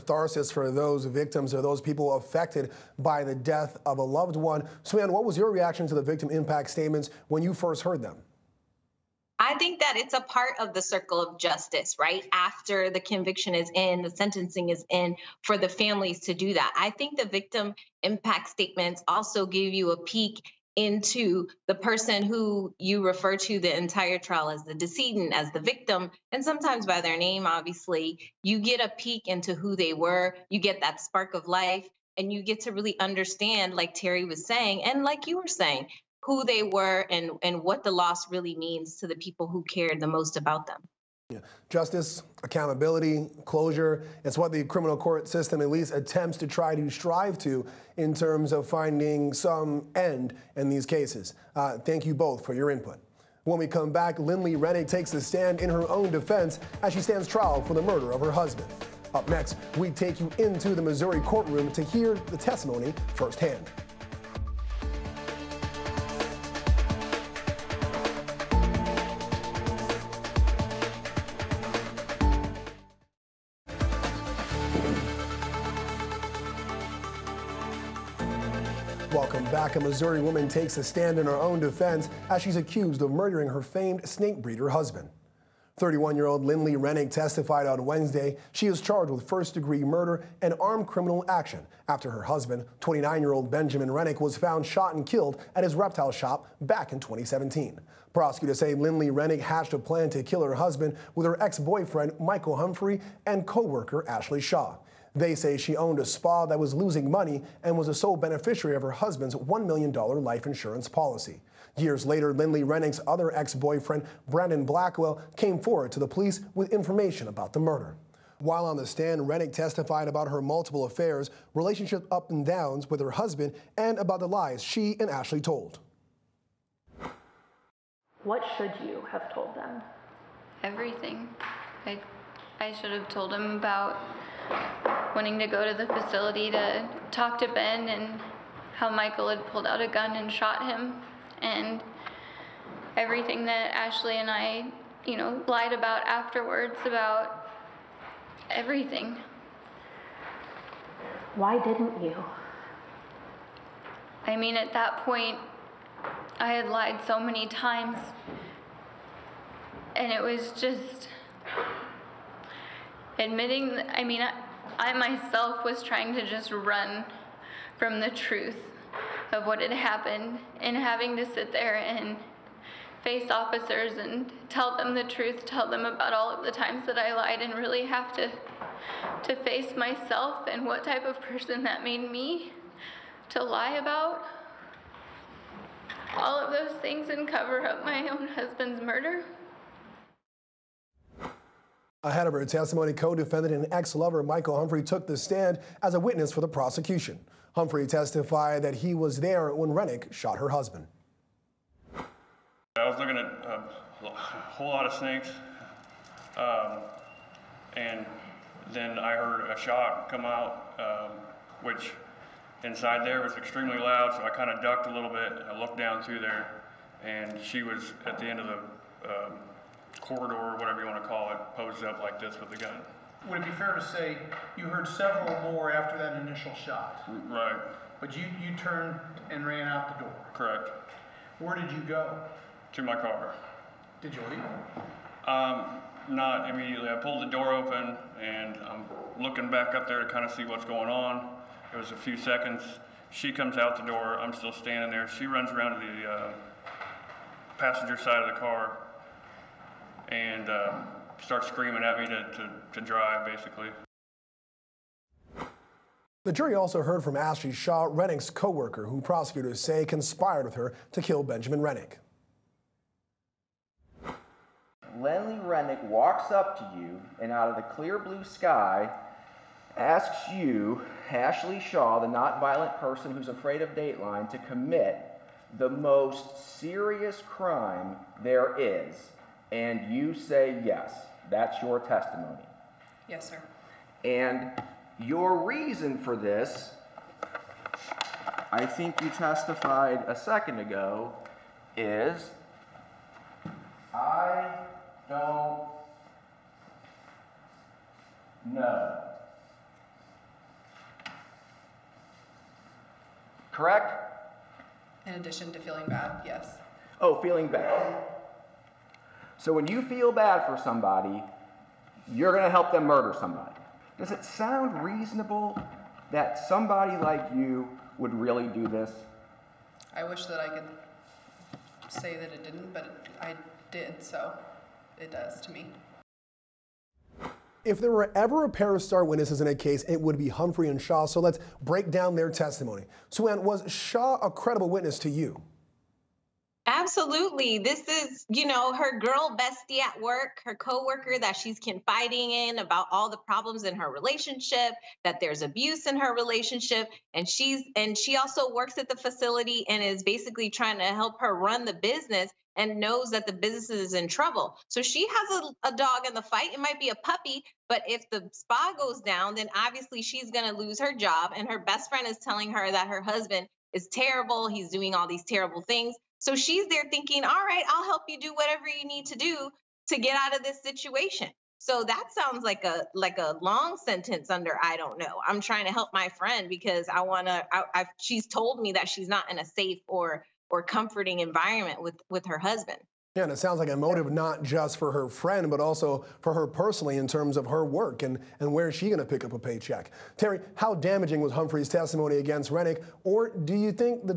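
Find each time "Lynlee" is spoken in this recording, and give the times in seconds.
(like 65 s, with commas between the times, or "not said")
54 s, 86 s, 98 s, 112 s, 264 s.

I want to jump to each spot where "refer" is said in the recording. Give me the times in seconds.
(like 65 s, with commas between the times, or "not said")
23 s.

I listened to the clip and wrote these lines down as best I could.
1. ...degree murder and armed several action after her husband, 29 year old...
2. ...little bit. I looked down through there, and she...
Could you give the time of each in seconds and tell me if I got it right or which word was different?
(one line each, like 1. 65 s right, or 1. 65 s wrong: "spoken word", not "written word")
1. 89 s wrong: "criminal", not "several"
2. 214 s right.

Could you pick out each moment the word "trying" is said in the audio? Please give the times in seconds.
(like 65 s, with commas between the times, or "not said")
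165 s, 350 s, 375 s.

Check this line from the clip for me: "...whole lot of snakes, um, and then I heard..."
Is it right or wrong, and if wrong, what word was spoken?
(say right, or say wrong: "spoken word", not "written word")
right.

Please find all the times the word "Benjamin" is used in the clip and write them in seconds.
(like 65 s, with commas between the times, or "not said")
93 s, 261 s.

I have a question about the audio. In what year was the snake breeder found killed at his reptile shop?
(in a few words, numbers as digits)
2017.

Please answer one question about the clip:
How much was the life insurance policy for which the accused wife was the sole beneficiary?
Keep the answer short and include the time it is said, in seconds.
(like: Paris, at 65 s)
$1 million, at 109 s.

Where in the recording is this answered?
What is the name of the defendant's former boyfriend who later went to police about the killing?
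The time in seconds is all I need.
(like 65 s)
114 s.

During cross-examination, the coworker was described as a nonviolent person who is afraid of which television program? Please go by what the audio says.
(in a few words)
Dateline.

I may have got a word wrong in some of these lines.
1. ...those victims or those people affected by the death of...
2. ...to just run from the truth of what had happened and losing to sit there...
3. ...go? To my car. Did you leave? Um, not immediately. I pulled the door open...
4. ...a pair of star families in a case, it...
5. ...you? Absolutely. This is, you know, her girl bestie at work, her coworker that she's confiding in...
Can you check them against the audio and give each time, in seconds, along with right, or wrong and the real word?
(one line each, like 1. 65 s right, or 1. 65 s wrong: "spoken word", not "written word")
1. 0 s right
2. 166 s wrong: "having", not "losing"
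3. 231 s right
4. 328 s wrong: "witnesses", not "families"
5. 335 s right.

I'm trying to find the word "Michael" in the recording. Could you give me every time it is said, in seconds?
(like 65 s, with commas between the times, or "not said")
102 s, 138 s, 194 s.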